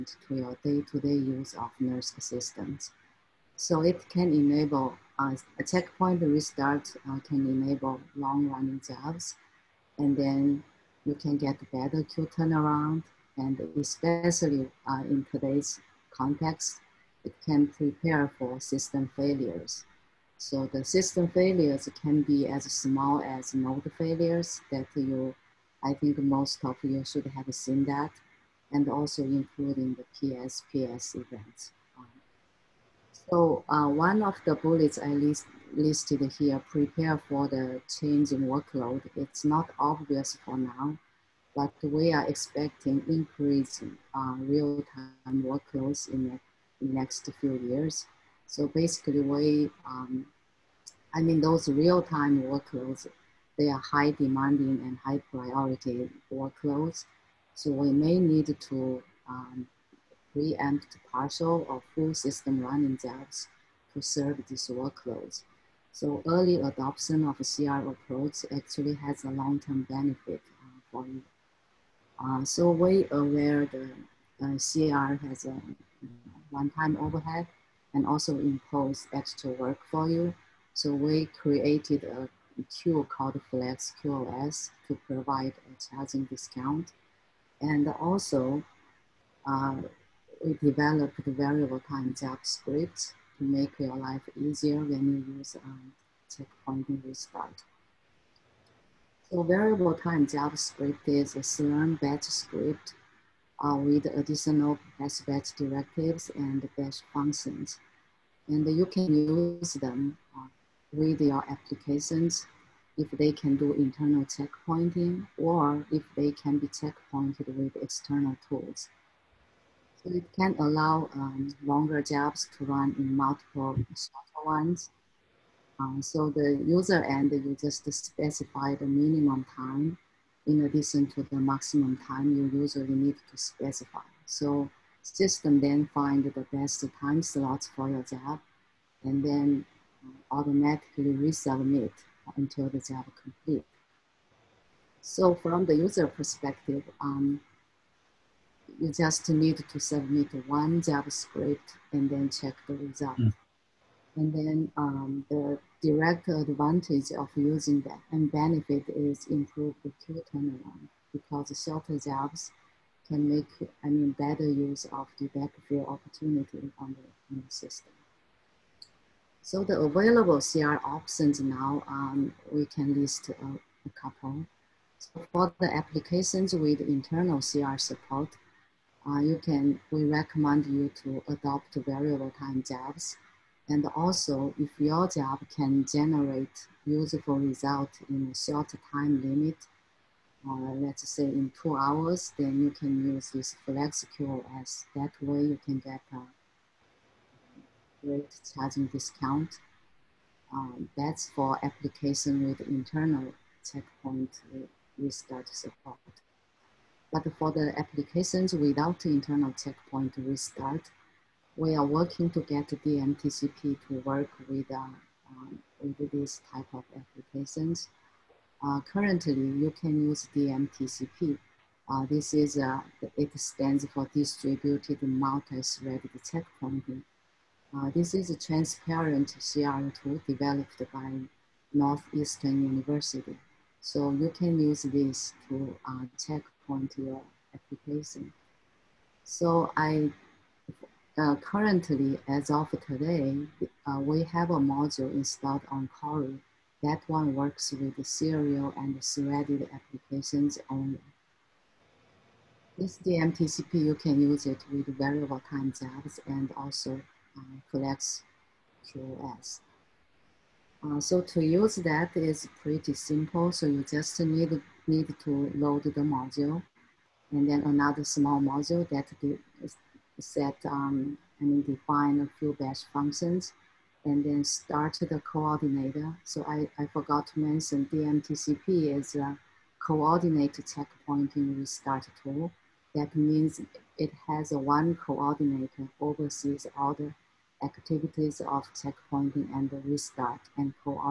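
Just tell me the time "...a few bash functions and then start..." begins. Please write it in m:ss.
4:32.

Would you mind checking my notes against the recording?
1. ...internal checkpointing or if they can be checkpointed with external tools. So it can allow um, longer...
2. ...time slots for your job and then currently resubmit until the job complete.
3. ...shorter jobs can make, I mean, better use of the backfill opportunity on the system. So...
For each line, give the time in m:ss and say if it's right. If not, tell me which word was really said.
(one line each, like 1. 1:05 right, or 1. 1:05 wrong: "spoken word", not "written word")
1. 1:53 right
2. 2:16 wrong: "automatically", not "currently"
3. 2:41 right.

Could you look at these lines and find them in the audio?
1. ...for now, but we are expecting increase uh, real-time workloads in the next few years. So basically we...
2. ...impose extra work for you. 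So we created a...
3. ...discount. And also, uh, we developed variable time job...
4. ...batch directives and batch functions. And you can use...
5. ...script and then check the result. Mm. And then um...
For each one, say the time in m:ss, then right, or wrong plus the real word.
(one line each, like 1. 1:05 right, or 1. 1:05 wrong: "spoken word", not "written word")
1. 0:40 right
2. 1:18 right
3. 1:26 right
4. 1:45 right
5. 2:31 right.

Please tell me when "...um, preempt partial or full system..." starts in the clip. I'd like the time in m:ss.
0:59.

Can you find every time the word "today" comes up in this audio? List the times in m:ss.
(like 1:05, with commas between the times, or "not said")
0:15, 4:02.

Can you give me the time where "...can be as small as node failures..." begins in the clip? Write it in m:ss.
0:22.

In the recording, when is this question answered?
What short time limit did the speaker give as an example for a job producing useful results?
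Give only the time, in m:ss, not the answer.
3:11.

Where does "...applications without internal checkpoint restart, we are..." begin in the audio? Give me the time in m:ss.
3:27.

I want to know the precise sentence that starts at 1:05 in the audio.
So early adoption of a CR approach actually has a long-term benefit uh, for you.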